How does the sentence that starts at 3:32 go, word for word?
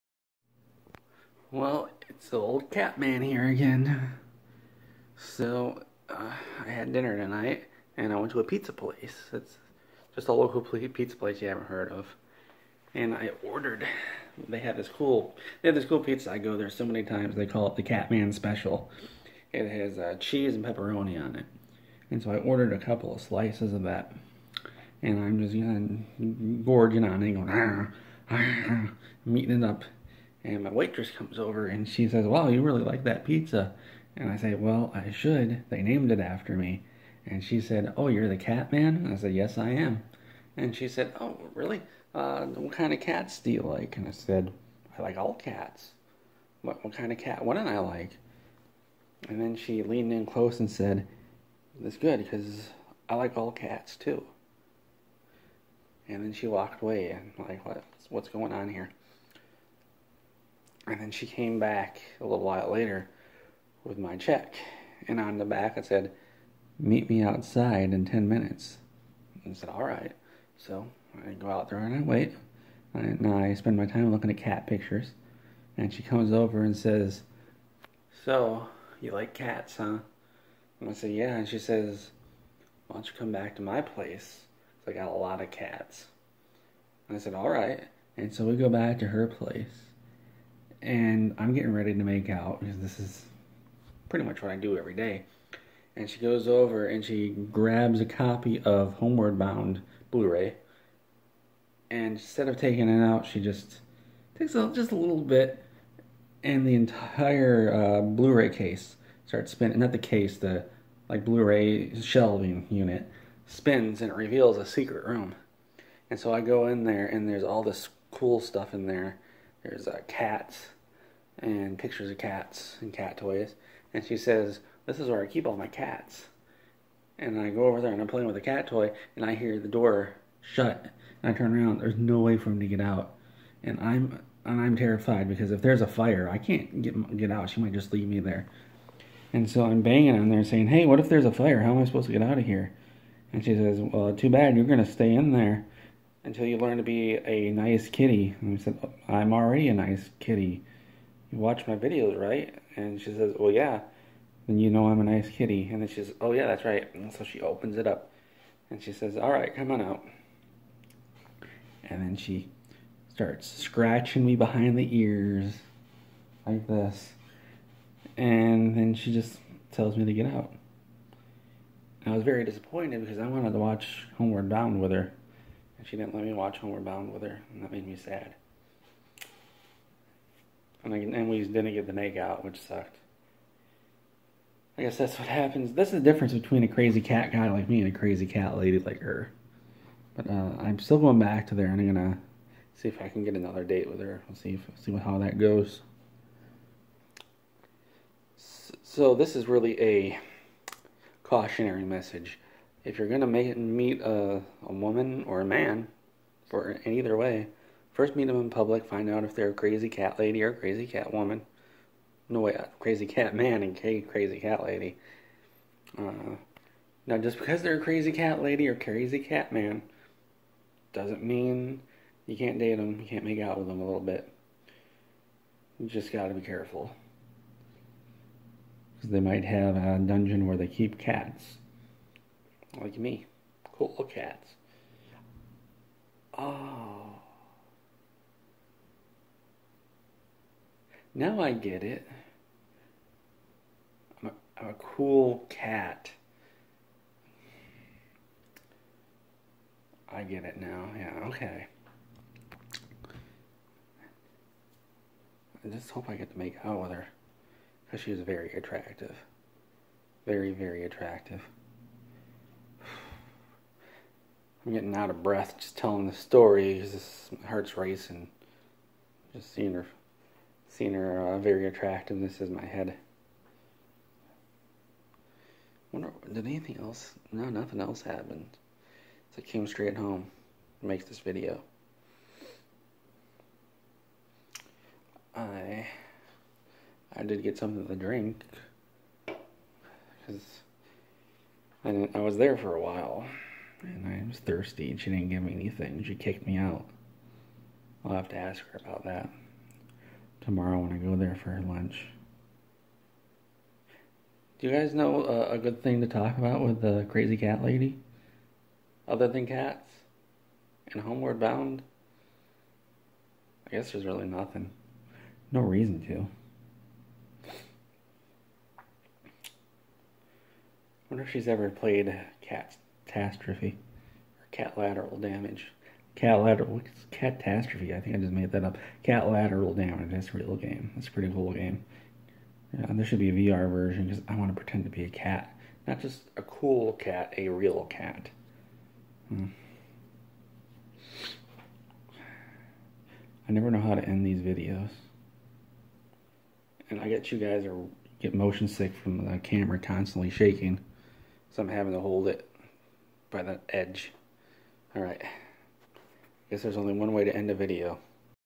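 No way, crazy cat man and crazy cat lady.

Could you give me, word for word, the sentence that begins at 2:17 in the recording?
She might just leave me there.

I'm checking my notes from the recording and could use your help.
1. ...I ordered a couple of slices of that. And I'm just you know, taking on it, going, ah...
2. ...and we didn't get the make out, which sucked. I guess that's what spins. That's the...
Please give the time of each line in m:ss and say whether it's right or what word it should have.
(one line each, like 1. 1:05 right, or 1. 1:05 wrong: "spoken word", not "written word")
1. 0:22 wrong: "gorging", not "taking"
2. 3:00 wrong: "happens", not "spins".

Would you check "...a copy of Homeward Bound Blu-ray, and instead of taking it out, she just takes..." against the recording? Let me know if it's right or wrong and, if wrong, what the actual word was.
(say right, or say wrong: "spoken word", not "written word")
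right.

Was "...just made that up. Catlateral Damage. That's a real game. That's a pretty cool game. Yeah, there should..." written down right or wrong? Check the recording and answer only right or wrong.
right.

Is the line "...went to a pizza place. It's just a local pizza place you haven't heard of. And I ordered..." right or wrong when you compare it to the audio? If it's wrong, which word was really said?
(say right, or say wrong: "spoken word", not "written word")
right.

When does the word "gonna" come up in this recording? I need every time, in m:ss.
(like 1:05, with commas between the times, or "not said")
3:11, 3:23.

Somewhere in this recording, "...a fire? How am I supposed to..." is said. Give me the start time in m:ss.
2:21.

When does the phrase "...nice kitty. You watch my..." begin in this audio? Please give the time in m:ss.
2:29.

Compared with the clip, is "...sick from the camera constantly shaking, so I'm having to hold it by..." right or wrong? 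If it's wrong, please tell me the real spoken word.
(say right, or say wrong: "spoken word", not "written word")
right.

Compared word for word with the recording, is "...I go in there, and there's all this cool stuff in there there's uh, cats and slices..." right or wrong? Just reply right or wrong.
wrong.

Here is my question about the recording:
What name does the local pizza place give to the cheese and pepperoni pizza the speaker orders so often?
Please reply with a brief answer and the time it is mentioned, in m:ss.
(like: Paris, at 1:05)
Catman Special, at 0:17.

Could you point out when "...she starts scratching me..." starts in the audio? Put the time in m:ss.
2:42.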